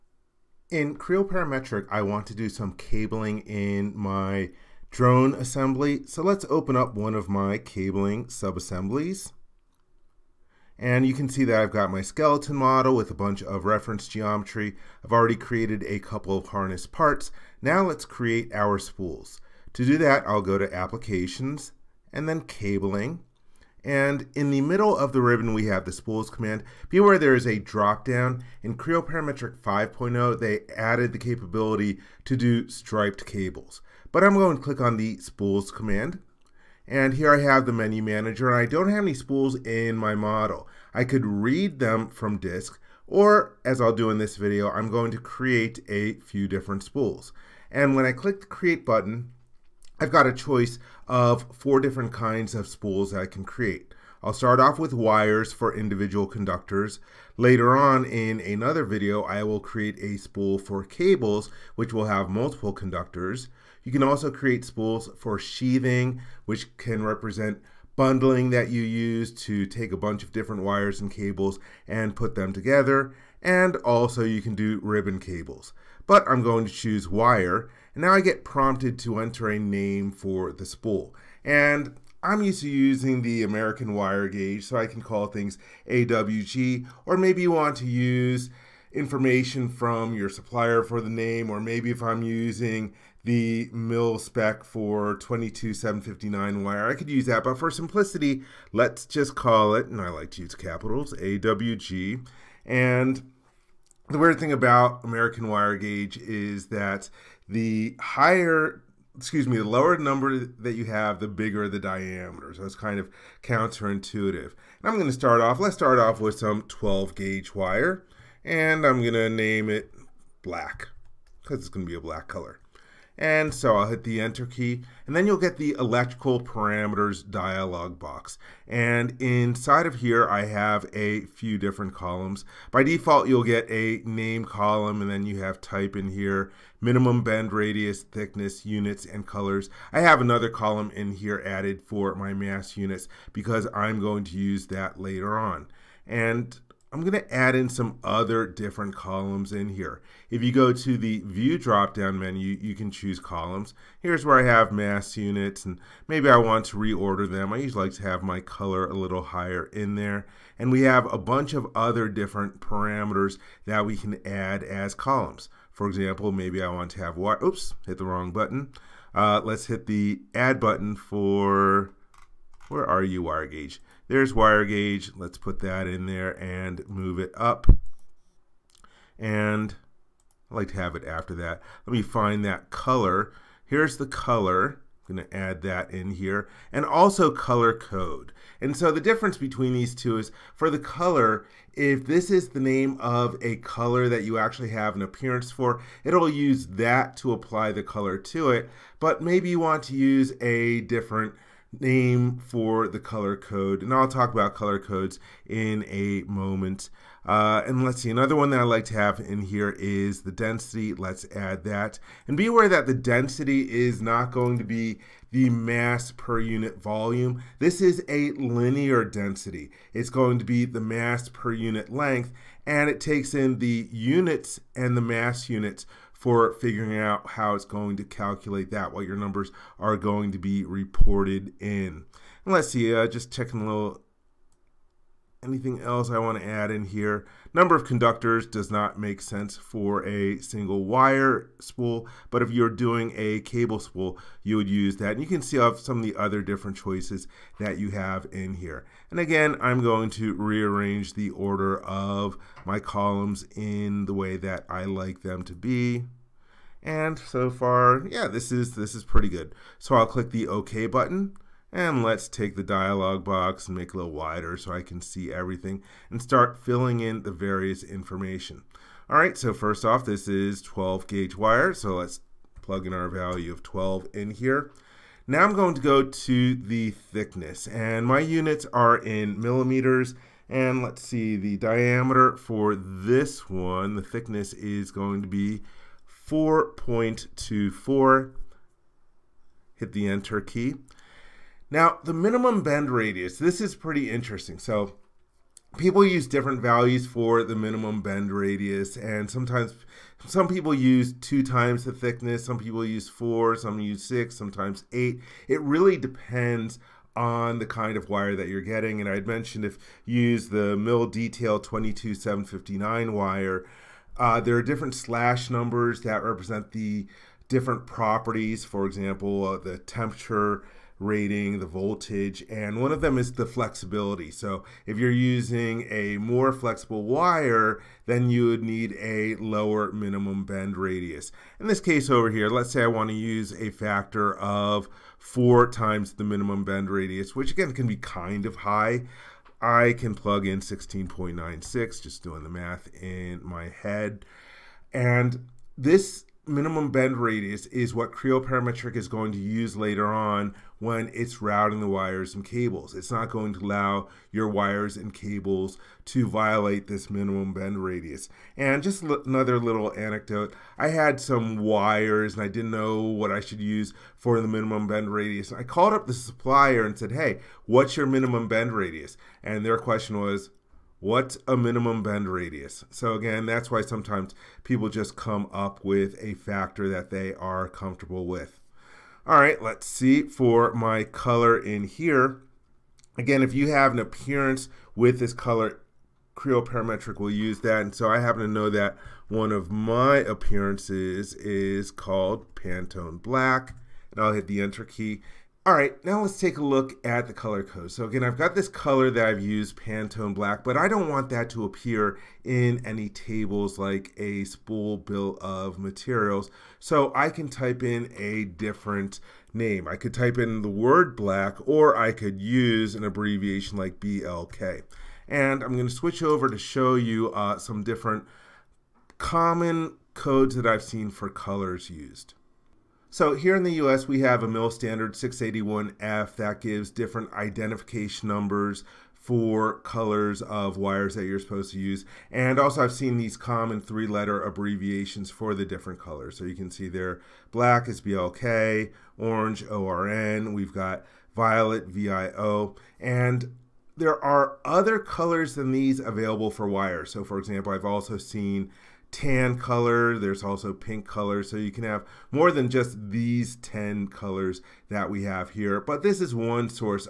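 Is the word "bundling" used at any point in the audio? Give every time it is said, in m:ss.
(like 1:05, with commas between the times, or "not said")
1:07.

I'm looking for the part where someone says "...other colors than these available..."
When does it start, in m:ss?
7:24.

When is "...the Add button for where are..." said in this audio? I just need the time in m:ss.
2:49.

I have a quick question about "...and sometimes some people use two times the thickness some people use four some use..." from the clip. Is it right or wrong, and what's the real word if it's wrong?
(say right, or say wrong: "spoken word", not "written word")
right.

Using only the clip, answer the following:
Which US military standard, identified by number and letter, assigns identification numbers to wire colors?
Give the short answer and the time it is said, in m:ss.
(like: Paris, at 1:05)
MIL standard 681F, at 7:04.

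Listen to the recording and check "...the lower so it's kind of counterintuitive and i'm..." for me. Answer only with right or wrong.
wrong.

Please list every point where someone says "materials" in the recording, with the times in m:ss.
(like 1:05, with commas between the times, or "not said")
6:45.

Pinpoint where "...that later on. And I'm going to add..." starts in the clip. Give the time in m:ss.
2:24.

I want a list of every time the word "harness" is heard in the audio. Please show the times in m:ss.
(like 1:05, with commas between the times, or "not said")
0:16.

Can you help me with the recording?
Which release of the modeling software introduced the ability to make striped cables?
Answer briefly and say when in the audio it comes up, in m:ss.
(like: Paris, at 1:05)
Creo Parametric 5.0, at 0:28.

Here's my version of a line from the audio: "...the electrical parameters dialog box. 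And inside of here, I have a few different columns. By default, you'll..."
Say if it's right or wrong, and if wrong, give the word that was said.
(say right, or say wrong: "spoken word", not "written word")
right.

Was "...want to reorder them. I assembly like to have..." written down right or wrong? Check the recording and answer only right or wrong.
wrong.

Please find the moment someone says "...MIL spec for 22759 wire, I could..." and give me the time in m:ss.
1:33.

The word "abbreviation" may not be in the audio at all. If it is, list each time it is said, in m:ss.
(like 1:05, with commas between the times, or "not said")
6:53, 7:14.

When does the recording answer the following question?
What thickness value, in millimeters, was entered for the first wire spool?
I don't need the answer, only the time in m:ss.
4:46.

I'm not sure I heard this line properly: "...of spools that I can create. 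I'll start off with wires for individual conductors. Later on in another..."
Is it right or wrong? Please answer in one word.
right.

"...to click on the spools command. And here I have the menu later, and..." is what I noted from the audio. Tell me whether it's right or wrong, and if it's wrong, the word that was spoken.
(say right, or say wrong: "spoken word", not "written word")
wrong: "manager", not "later".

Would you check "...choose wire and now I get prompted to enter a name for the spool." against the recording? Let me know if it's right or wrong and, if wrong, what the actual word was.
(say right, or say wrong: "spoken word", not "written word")
right.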